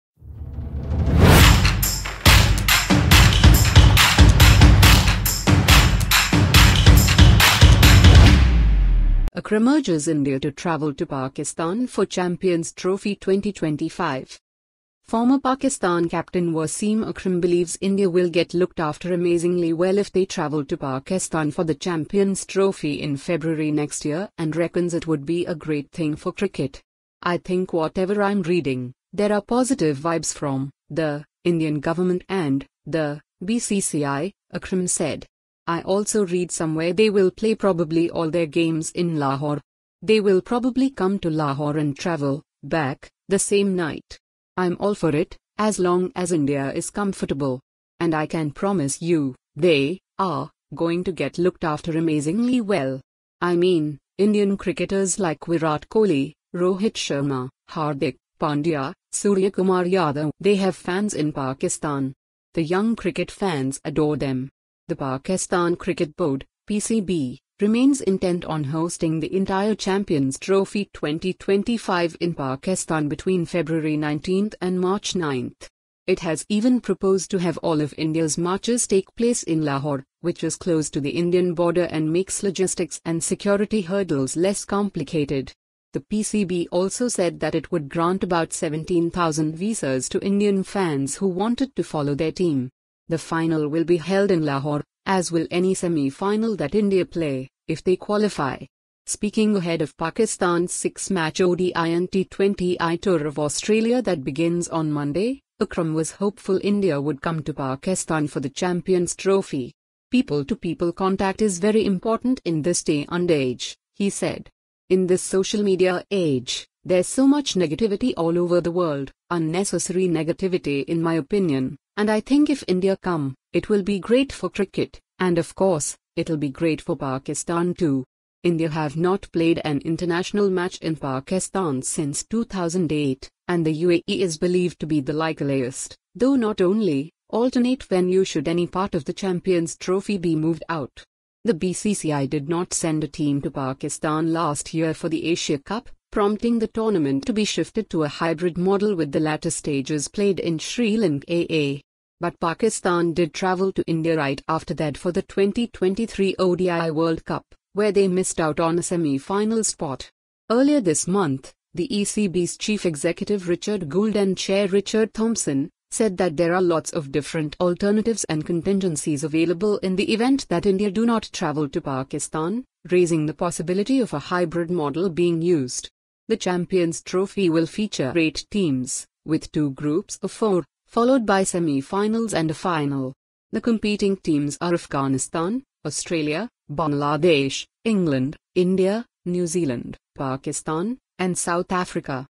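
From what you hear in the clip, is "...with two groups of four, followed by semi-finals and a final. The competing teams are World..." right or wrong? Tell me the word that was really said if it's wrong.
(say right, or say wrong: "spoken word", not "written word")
wrong: "Afghanistan", not "World".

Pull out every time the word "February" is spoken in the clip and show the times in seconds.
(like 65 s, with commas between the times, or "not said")
23 s, 73 s.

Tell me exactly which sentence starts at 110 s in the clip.
People-to-people contact is very important in this day and age, he said.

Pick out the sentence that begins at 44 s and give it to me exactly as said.
I'm all for it, as long as India is comfortable.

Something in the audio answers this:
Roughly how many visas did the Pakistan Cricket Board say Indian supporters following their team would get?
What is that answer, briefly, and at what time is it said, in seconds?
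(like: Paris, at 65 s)
17,000, at 88 s.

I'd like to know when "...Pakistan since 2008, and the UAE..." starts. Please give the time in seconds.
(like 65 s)
130 s.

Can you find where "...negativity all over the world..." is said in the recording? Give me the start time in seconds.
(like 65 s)
117 s.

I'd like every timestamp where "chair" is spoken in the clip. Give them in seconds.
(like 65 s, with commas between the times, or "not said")
164 s.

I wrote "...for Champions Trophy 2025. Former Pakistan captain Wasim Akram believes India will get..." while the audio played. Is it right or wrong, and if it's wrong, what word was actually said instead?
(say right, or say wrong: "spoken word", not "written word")
right.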